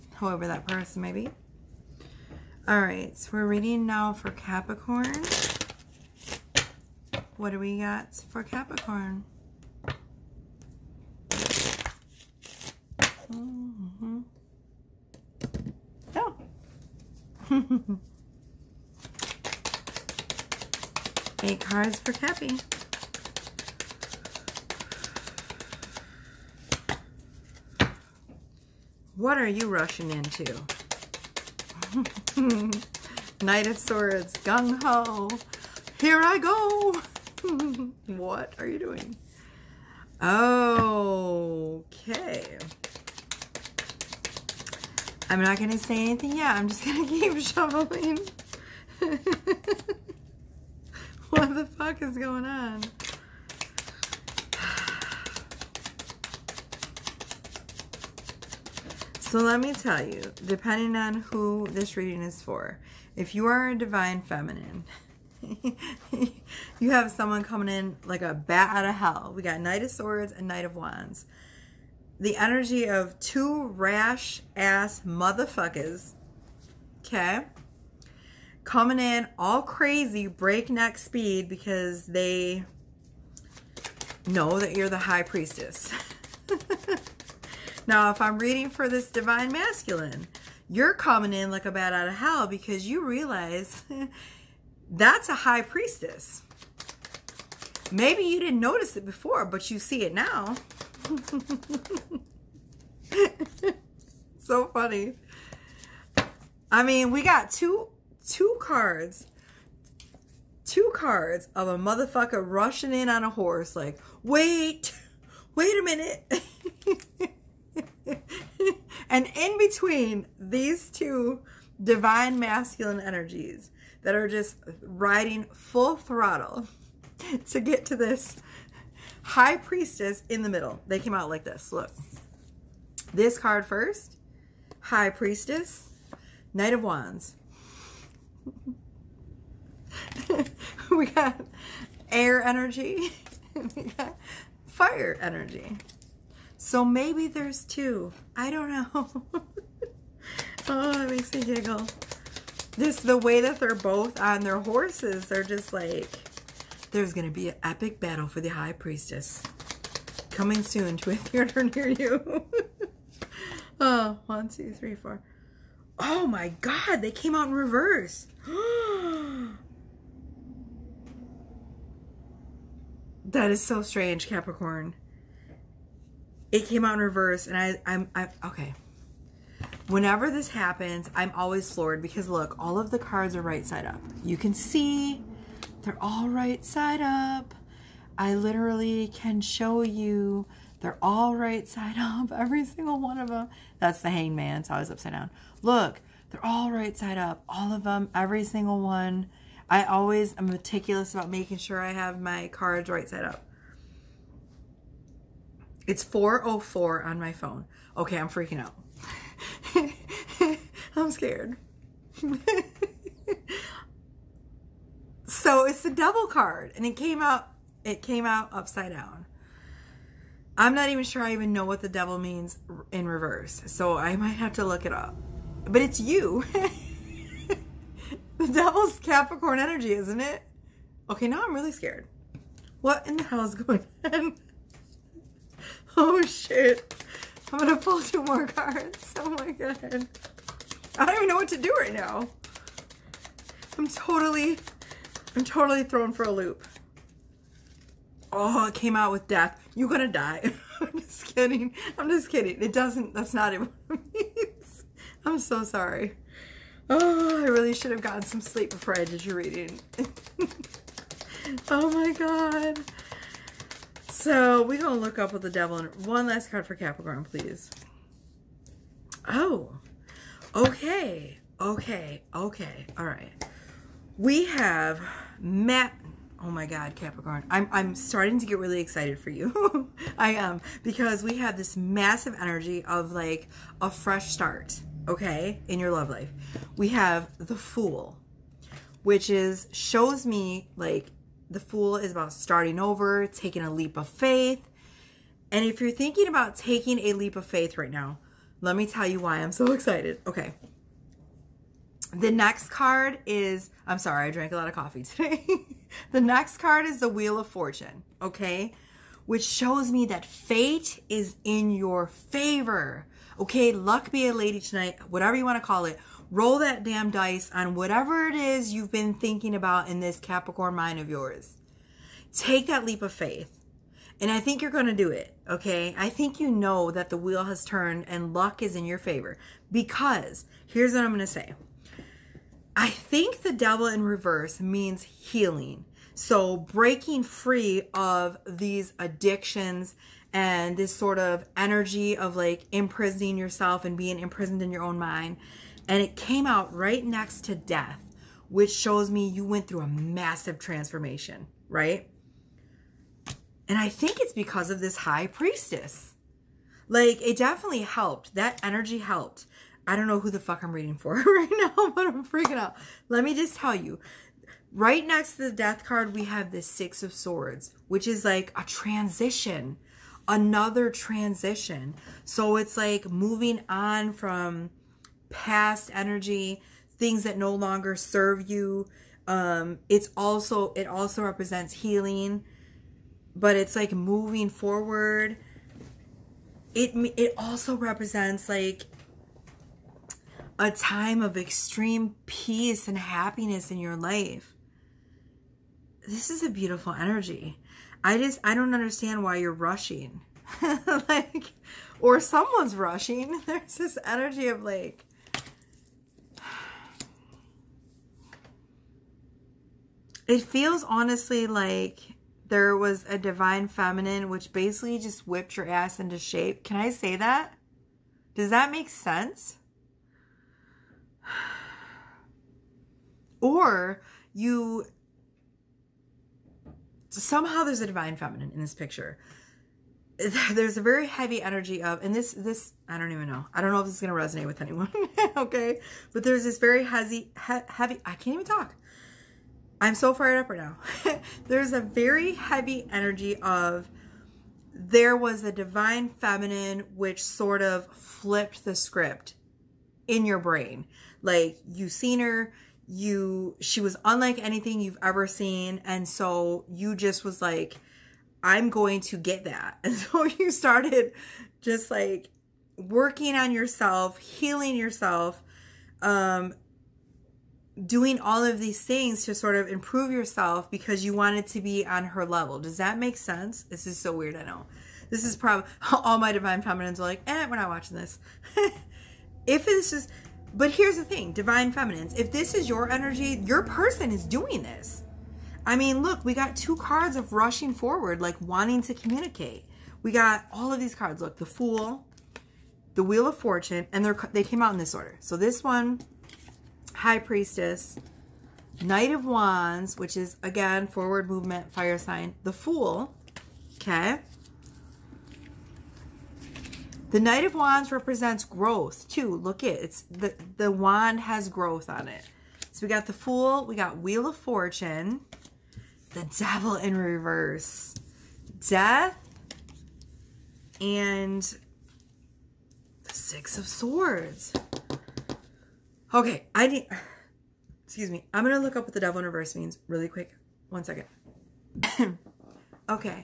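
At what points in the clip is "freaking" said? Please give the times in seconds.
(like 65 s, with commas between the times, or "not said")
208 s, 362 s.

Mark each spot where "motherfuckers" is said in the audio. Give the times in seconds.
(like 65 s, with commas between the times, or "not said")
75 s, 111 s.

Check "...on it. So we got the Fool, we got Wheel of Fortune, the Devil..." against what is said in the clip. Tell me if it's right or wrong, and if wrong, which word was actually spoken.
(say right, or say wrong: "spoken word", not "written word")
right.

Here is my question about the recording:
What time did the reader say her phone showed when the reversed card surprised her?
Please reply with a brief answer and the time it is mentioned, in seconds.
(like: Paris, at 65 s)
4:04, at 206 s.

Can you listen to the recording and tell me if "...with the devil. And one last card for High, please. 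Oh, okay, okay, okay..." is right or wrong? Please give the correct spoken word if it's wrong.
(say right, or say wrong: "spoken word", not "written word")
wrong: "Capricorn", not "High".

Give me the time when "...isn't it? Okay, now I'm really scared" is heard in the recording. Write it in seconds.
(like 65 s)
229 s.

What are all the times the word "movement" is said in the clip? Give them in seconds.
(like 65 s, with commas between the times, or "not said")
501 s.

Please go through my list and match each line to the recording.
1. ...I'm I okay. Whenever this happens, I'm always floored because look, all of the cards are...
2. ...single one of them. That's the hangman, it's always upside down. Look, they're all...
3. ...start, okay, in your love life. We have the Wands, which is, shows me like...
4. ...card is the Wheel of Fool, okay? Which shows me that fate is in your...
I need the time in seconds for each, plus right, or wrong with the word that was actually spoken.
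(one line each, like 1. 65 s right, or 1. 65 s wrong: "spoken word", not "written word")
1. 177 s right
2. 192 s right
3. 284 s wrong: "Fool", not "Wands"
4. 306 s wrong: "Fortune", not "Fool".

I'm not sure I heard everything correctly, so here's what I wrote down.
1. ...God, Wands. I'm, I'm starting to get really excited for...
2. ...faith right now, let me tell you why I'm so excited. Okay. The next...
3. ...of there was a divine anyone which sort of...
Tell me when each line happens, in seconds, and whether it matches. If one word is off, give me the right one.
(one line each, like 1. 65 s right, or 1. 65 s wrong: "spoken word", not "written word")
1. 276 s wrong: "Capricorn", not "Wands"
2. 297 s right
3. 443 s wrong: "feminine", not "anyone".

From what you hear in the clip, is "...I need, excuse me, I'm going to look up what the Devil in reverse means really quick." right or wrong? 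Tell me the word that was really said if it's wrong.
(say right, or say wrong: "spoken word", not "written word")
right.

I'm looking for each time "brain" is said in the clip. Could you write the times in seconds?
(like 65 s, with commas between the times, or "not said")
450 s.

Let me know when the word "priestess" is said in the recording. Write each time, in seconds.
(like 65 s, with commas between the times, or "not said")
85 s, 95 s, 129 s, 135 s, 158 s, 355 s, 497 s.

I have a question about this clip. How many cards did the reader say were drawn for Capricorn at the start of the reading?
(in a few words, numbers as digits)
8.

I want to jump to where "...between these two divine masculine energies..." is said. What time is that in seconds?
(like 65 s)
119 s.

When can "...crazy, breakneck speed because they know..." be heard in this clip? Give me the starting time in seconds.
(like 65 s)
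79 s.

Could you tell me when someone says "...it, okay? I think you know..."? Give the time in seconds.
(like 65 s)
325 s.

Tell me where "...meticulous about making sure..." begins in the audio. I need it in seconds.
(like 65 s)
200 s.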